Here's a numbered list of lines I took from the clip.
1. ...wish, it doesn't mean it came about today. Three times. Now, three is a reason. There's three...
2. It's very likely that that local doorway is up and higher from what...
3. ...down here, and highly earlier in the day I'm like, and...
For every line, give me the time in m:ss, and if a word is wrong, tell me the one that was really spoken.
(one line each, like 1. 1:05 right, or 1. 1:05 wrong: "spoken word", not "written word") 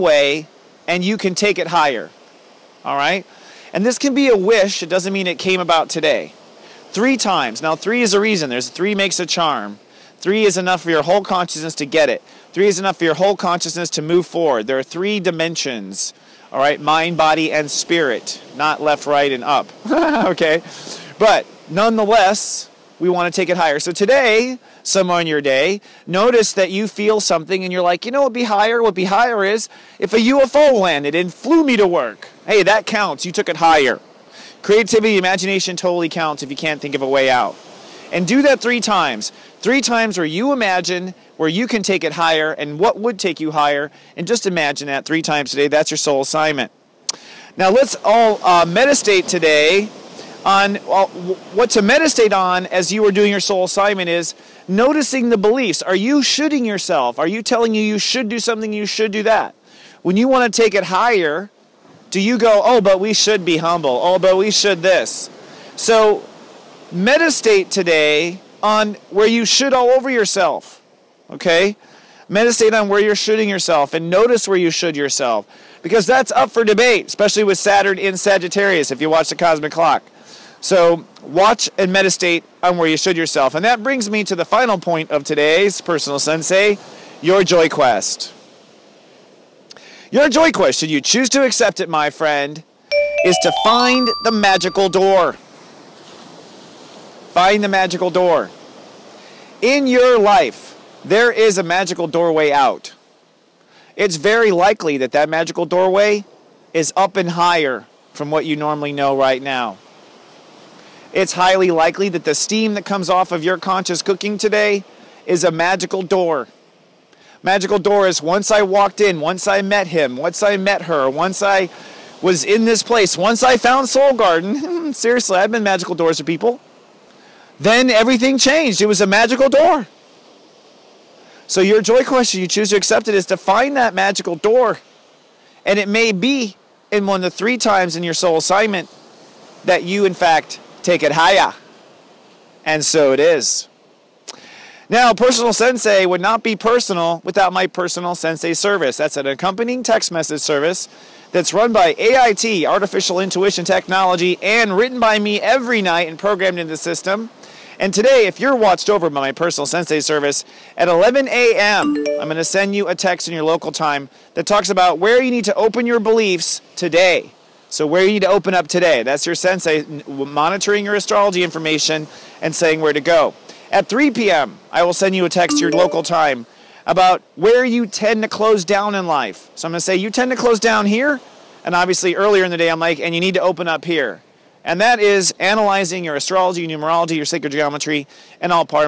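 1. 0:04 right
2. 1:43 wrong: "magical", not "local"
3. 3:00 wrong: "obviously", not "highly".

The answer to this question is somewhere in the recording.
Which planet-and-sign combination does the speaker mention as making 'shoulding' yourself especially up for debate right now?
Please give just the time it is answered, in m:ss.
1:17.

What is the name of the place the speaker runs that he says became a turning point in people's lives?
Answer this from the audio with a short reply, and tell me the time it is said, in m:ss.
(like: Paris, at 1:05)
Soul Garden, at 2:03.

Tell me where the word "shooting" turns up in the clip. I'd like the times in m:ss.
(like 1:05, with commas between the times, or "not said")
0:56, 1:13.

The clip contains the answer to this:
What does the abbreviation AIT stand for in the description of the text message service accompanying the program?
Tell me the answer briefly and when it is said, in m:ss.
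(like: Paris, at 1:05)
Artificial Intuition Technology, at 2:32.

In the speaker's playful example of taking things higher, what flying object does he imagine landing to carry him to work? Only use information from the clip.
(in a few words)
UFO.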